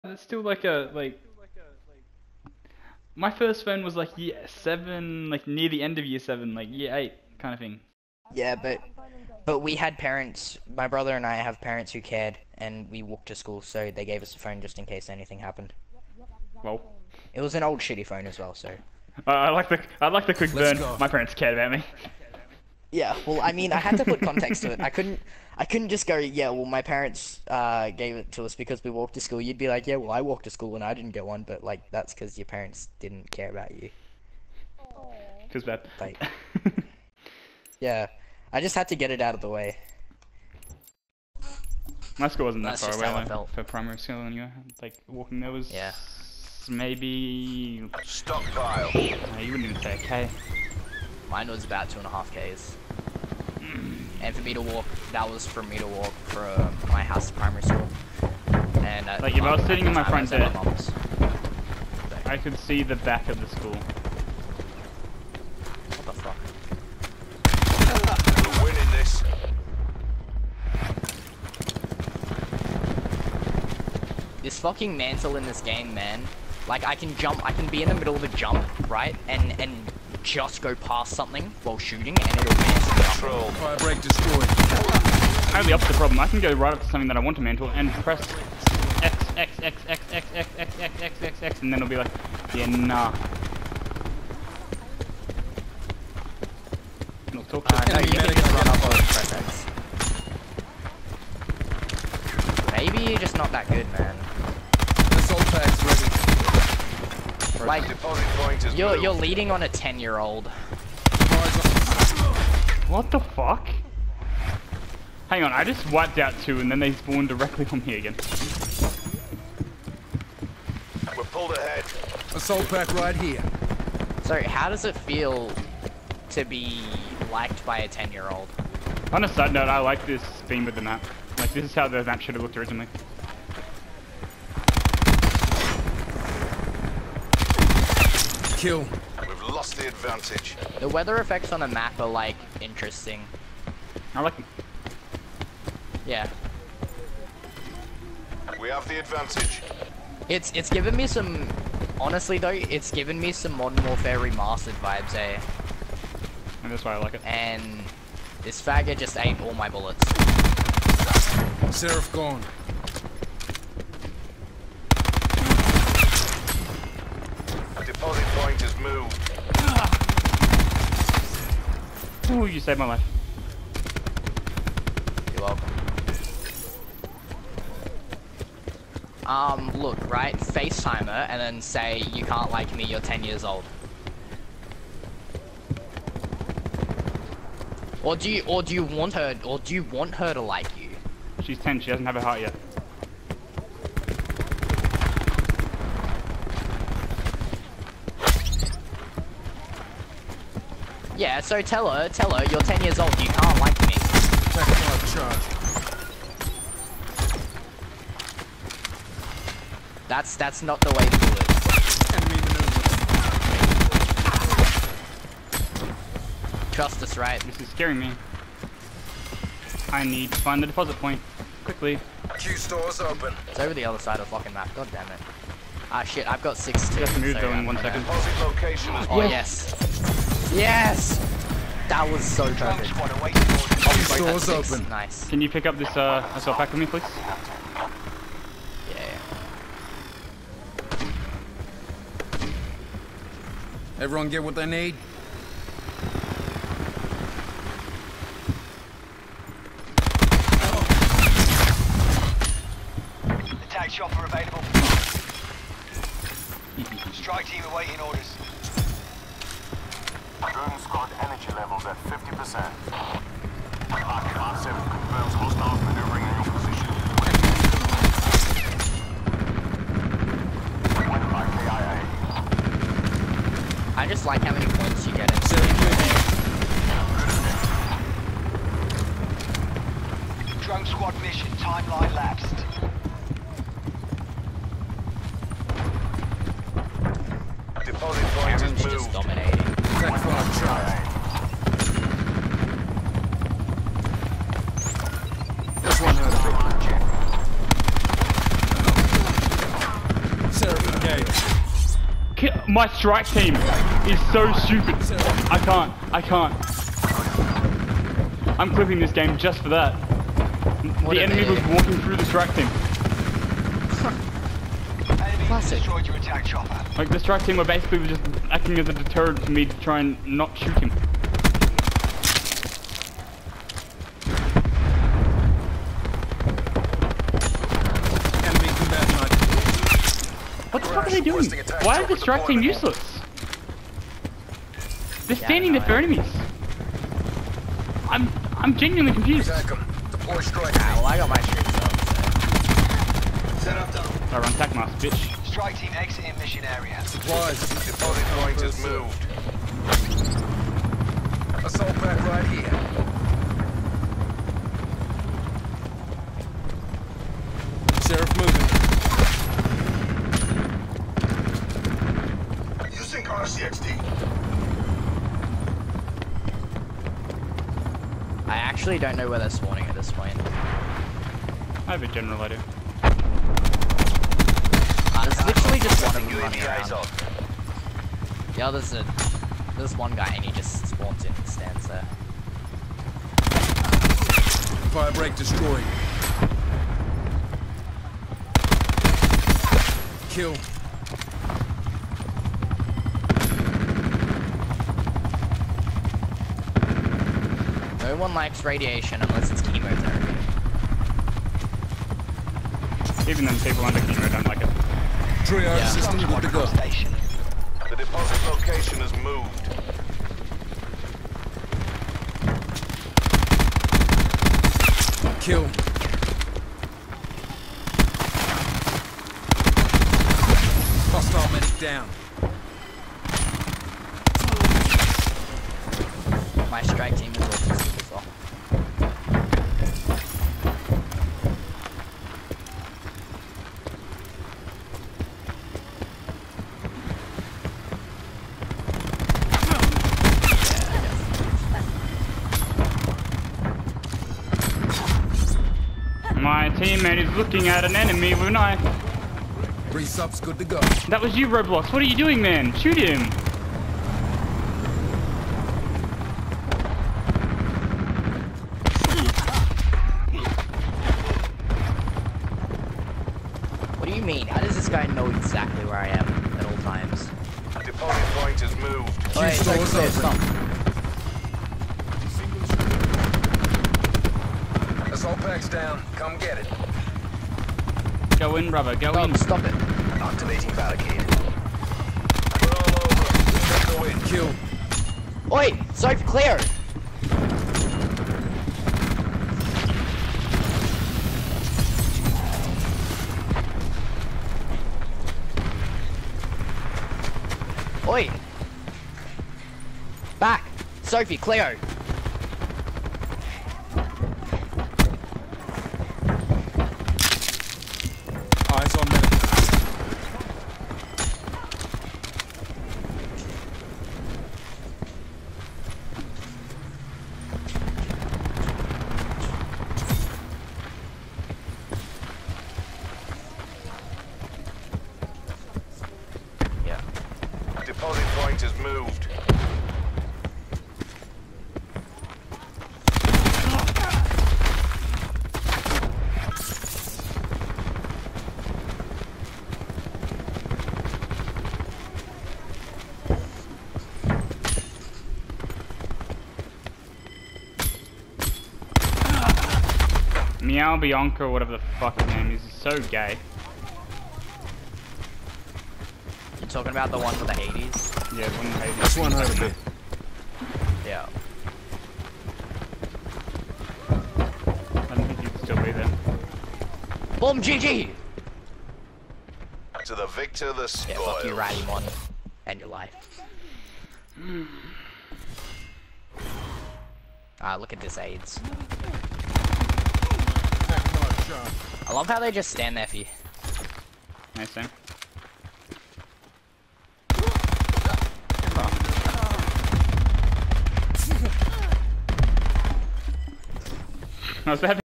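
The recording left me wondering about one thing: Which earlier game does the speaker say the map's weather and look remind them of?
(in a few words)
Modern Warfare Remastered.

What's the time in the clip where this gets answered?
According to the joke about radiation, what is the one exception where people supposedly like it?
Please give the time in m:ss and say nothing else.
6:39.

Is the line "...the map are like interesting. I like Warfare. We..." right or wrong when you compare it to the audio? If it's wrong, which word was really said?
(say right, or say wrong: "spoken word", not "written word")
wrong: "Yeah", not "Warfare".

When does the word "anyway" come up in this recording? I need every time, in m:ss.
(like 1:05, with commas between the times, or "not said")
0:44.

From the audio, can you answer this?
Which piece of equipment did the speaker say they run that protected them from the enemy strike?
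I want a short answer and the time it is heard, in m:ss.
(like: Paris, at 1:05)
Tac mask, at 5:44.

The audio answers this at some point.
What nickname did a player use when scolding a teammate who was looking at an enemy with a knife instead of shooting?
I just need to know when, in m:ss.
7:31.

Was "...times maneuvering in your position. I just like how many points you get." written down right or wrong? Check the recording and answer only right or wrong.
wrong.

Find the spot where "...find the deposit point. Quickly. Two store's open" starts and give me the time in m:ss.
3:40.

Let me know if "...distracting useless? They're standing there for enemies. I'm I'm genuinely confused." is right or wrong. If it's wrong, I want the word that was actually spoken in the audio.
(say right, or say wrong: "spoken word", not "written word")
right.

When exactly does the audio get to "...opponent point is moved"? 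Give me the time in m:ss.
7:47.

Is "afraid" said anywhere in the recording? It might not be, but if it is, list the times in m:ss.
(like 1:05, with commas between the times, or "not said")
not said.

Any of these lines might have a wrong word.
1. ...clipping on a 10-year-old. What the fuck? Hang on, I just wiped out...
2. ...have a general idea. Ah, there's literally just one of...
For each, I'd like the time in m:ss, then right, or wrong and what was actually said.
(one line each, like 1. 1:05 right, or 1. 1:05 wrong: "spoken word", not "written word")
1. 1:49 wrong: "leading", not "clipping"
2. 6:11 right.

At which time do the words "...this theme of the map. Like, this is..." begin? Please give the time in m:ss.
2:10.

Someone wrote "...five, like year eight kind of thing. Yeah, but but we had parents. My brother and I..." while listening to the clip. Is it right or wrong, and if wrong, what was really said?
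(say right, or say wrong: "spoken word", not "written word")
wrong: "seven", not "five".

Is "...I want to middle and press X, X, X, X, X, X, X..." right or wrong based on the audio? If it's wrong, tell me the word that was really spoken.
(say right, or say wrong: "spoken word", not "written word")
wrong: "mantle", not "middle".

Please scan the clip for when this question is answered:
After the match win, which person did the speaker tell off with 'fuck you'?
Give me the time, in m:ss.
9:31.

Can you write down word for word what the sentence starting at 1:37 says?
it'll talk to uh, no, you can just run up over Maybe you're just not that good, man.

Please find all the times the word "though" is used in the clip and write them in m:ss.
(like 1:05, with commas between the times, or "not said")
2:32, 3:47.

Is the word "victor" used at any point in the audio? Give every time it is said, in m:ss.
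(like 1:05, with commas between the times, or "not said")
9:30.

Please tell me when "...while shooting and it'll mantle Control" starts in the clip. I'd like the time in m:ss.
1:21.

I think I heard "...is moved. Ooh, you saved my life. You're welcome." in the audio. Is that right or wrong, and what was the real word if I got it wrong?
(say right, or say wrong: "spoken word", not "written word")
right.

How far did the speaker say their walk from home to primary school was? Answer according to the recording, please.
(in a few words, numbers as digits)
2.5 km.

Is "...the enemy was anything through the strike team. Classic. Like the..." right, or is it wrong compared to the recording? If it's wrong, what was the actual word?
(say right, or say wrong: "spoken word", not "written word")
wrong: "walking", not "anything".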